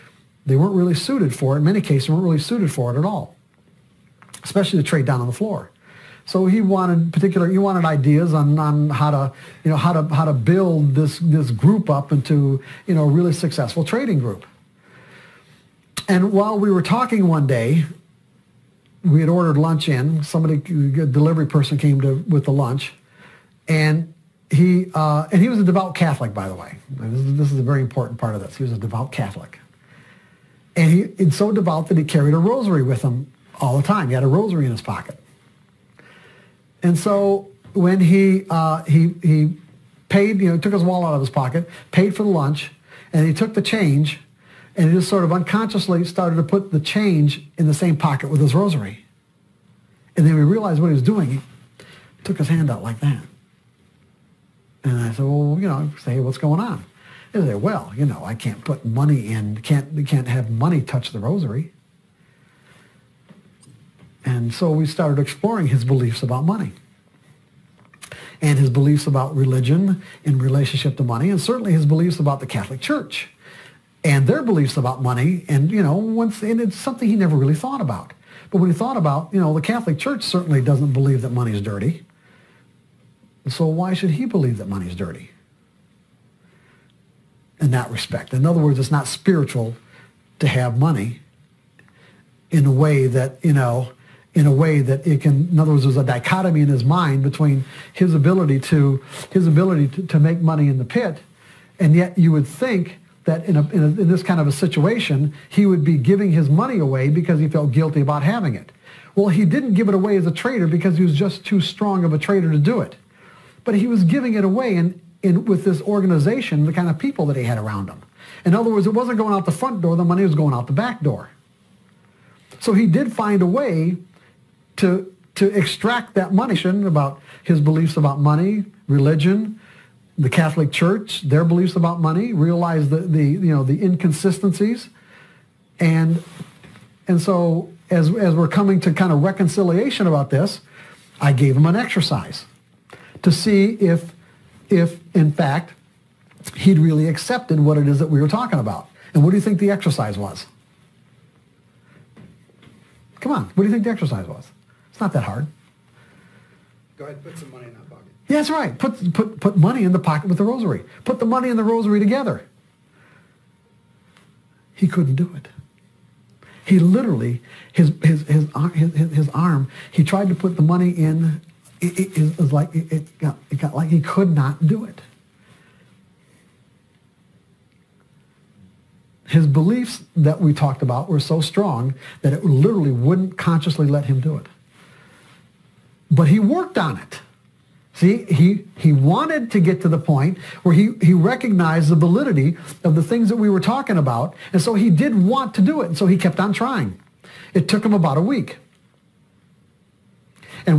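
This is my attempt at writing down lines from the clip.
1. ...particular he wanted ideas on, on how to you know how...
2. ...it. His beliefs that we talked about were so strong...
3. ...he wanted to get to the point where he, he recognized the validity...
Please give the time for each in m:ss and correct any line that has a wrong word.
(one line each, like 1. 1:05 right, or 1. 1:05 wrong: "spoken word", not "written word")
1. 0:07 right
2. 2:54 right
3. 3:08 right.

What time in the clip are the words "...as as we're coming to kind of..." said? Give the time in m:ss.
2:17.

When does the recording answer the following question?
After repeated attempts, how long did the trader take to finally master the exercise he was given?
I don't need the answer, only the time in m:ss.
3:17.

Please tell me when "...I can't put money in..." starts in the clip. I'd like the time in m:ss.
0:58.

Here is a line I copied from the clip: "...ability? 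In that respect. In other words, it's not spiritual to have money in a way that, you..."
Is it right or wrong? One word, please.
wrong.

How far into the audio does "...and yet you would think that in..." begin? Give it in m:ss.
1:41.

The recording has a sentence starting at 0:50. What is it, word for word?
And then we realized what he was doing.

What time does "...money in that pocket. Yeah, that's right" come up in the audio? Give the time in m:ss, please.
2:37.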